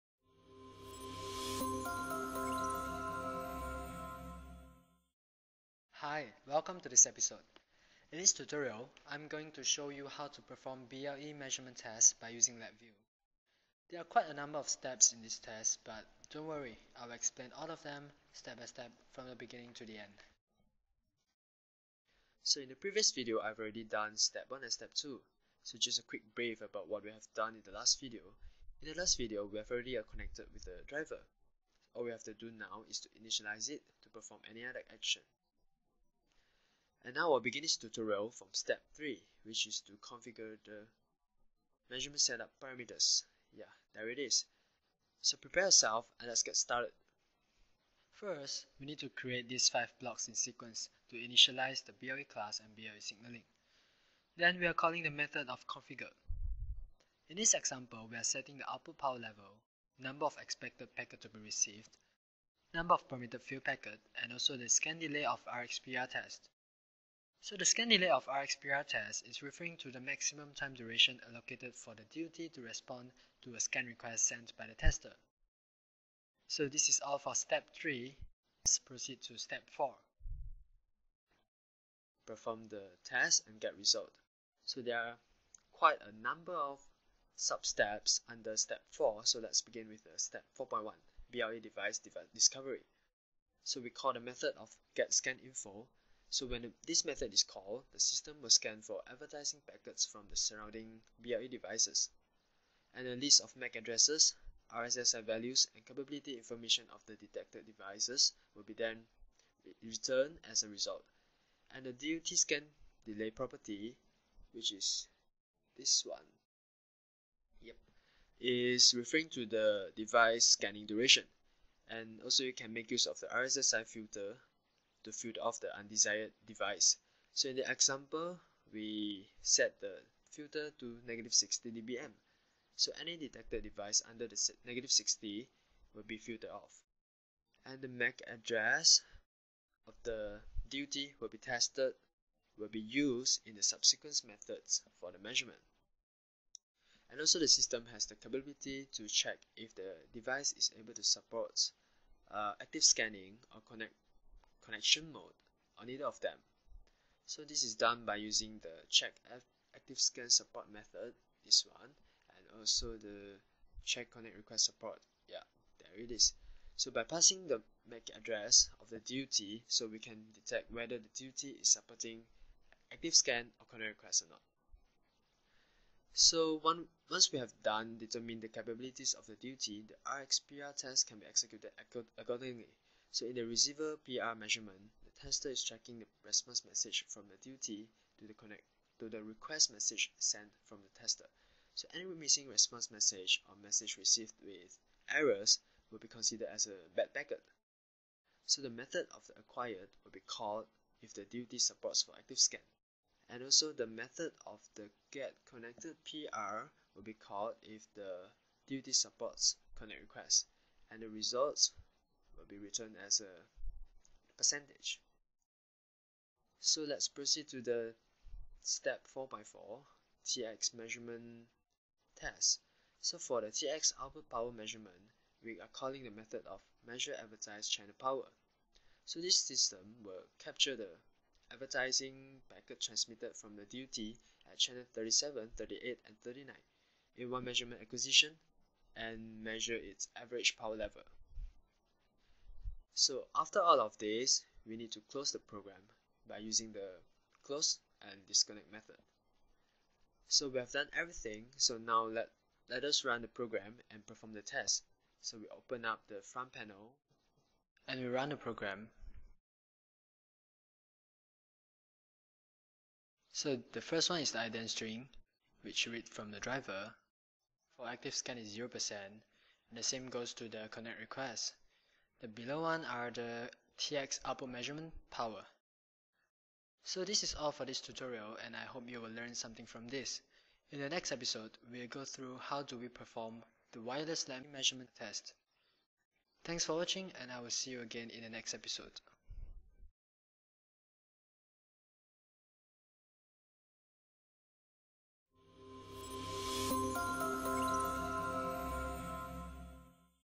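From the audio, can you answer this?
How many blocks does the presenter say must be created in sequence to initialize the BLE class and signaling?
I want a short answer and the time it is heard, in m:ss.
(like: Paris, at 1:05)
5, at 0:49.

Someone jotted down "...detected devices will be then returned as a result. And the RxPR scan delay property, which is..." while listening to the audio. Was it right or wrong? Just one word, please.
wrong.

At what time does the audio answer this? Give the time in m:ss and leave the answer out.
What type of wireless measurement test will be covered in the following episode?
4:43.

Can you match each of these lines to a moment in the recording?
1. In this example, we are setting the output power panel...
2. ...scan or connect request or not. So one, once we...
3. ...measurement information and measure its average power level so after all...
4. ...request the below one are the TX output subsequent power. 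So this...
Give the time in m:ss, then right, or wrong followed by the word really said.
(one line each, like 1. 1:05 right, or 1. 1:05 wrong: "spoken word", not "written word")
1. 0:57 wrong: "level", not "panel"
2. 2:53 right
3. 3:57 wrong: "acquisition", not "information"
4. 4:30 wrong: "measurement", not "subsequent".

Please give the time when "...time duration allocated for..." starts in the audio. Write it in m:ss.
1:10.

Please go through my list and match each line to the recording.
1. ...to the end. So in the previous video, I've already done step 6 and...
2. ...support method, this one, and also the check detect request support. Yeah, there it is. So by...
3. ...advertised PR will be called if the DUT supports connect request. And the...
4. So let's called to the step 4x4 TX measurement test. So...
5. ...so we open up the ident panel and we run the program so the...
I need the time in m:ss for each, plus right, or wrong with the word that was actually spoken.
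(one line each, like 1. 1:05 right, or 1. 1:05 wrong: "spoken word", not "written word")
1. 0:19 wrong: "1", not "6"
2. 2:40 wrong: "connect", not "detect"
3. 3:25 wrong: "connected", not "advertised"
4. 3:36 wrong: "proceed", not "called"
5. 4:15 wrong: "front", not "ident".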